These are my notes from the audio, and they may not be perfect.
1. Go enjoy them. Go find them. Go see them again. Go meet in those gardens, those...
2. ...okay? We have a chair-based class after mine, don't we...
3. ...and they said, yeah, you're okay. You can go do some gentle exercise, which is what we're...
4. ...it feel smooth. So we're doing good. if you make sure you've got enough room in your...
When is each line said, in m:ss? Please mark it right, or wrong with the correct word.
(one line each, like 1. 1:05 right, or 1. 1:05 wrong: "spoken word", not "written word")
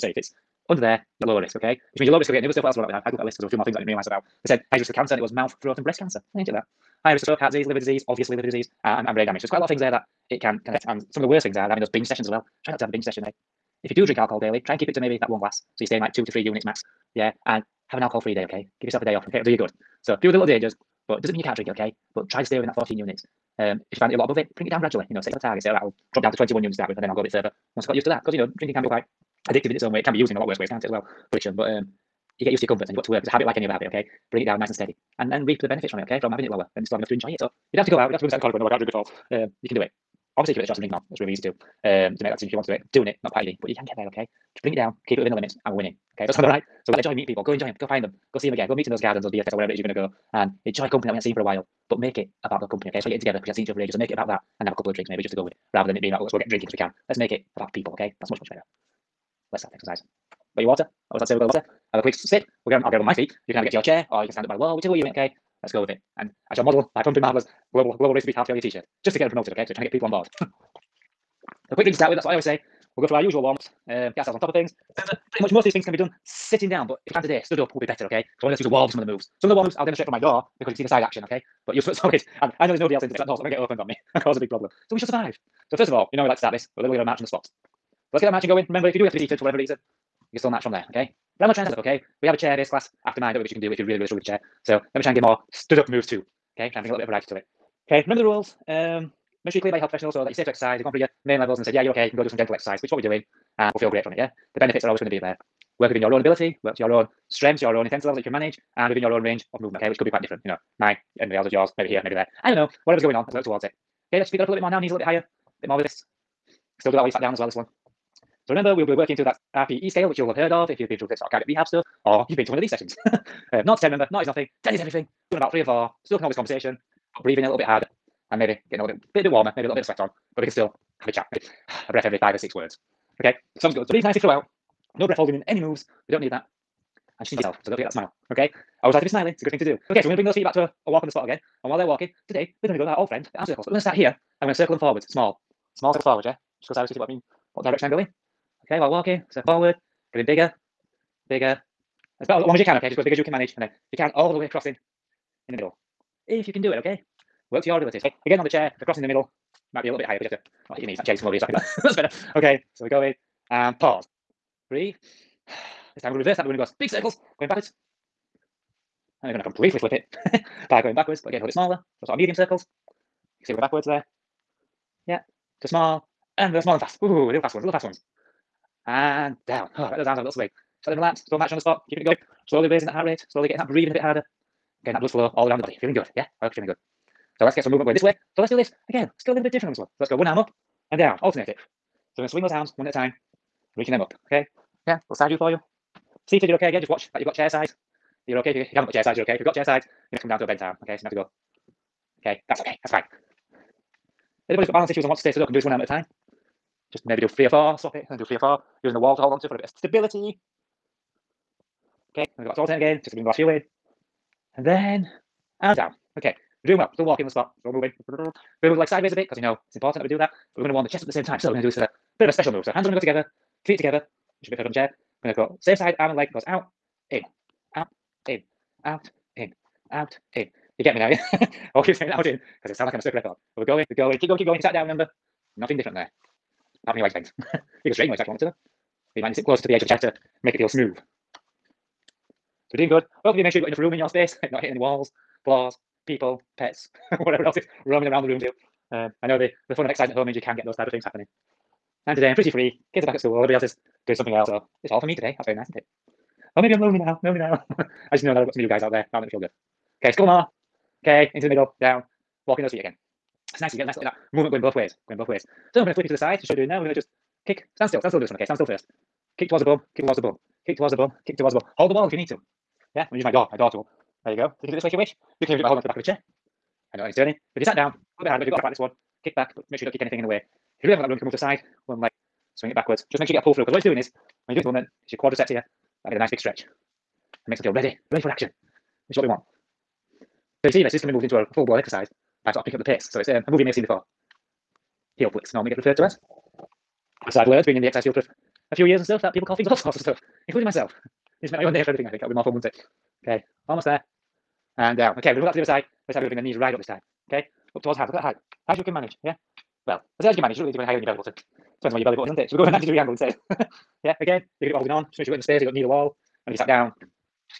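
1. 0:47 right
2. 1:31 right
3. 1:41 right
4. 4:00 right.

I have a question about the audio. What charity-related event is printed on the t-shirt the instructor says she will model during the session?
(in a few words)
Global Race to Beat Heart Failure.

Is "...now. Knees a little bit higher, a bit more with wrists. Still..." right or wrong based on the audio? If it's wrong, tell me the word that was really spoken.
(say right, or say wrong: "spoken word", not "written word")
right.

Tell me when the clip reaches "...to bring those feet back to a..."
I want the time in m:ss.
2:20.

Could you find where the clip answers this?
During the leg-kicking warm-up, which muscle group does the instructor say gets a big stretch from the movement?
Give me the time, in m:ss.
4:45.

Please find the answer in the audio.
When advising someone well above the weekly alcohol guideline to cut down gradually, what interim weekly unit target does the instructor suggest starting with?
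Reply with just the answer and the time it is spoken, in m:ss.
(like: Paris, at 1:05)
21 units, at 0:26.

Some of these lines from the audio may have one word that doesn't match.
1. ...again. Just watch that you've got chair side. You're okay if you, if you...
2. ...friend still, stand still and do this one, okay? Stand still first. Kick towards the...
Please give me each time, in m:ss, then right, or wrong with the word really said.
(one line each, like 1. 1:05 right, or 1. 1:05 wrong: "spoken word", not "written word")
1. 3:16 right
2. 4:27 wrong: "stand", not "friend".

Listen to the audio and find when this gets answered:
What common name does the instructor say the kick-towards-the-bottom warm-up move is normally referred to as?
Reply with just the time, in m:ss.
4:55.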